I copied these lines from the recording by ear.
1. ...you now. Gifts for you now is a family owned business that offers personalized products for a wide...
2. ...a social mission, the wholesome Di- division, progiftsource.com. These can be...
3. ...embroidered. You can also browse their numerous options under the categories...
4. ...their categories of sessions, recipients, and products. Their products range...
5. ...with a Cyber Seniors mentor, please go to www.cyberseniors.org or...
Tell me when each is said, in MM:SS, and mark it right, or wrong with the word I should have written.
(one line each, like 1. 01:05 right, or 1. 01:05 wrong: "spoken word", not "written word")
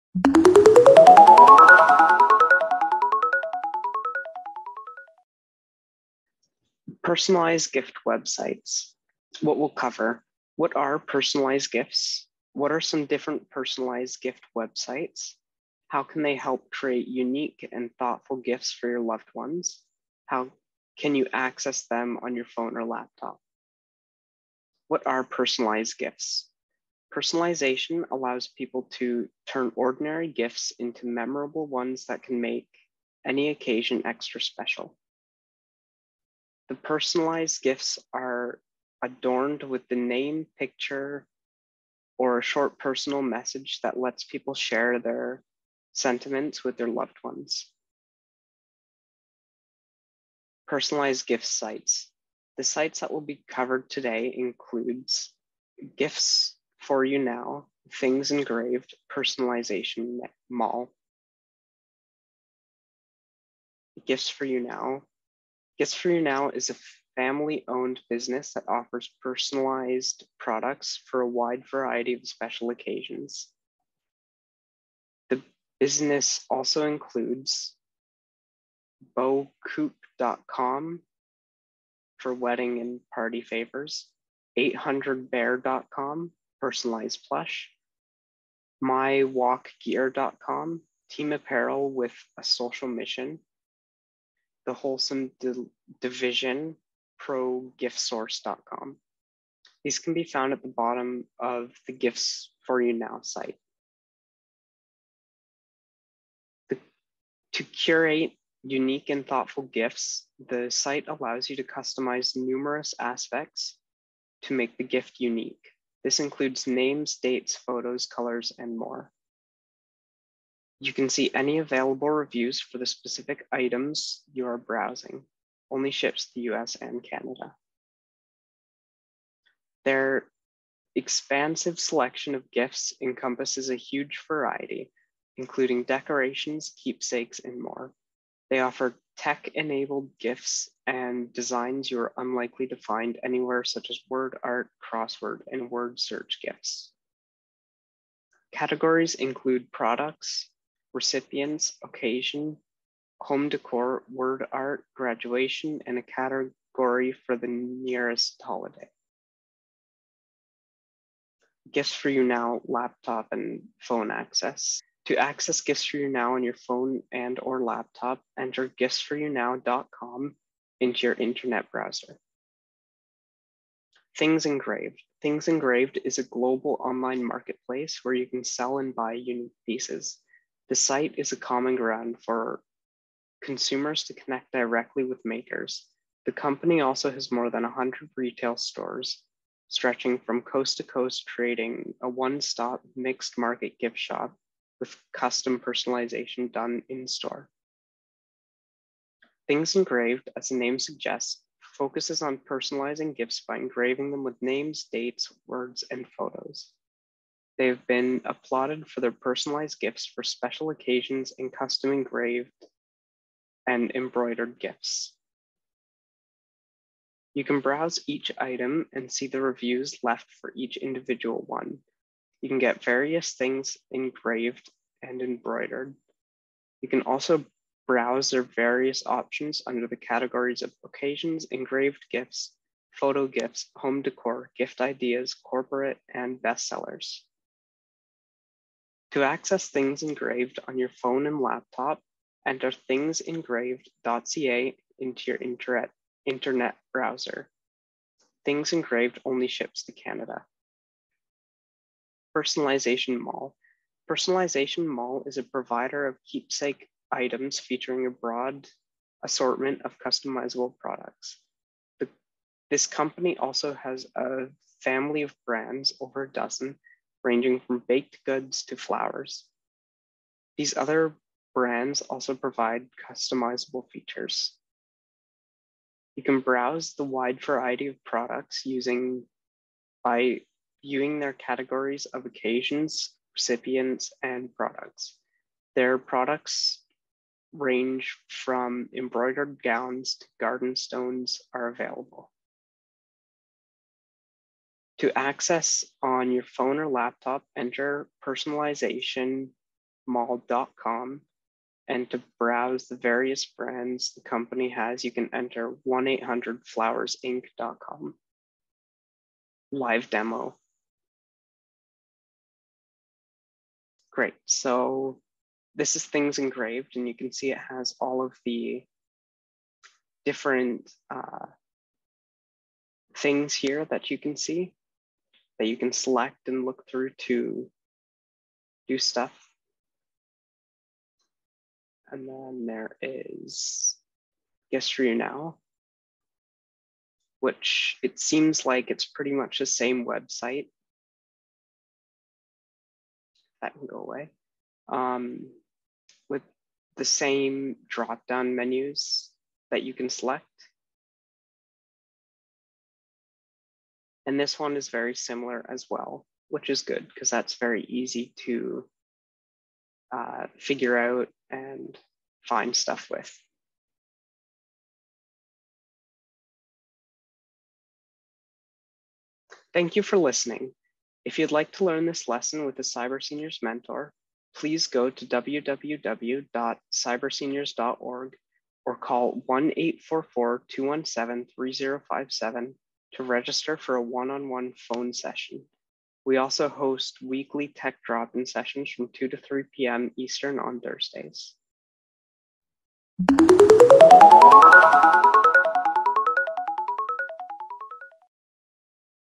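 1. 01:04 right
2. 01:32 right
3. 03:45 wrong: "various", not "numerous"
4. 04:41 wrong: "occasions", not "sessions"
5. 06:12 right.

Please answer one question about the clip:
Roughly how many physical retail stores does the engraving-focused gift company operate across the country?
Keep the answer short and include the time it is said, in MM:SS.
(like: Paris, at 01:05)
more than 100, at 03:07.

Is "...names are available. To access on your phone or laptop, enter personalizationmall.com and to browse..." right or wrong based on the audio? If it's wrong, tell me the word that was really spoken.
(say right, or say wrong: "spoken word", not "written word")
wrong: "stones", not "names".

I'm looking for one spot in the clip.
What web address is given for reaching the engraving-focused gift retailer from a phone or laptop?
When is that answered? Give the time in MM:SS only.
04:02.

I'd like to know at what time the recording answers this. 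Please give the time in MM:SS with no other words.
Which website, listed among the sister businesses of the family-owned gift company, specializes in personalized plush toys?
01:24.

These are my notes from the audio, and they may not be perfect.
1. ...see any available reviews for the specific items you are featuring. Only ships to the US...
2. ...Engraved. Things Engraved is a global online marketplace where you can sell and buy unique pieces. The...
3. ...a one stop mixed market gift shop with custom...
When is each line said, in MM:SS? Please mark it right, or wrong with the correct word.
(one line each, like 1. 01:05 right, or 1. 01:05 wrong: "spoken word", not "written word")
1. 02:01 wrong: "browsing", not "featuring"
2. 02:54 right
3. 03:12 right.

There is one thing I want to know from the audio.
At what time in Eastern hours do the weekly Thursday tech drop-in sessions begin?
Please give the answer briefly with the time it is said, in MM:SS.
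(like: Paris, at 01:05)
2 p.m., at 06:29.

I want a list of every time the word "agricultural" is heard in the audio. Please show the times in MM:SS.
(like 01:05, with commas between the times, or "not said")
not said.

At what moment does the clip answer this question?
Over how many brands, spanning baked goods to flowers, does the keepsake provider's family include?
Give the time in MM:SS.
04:25.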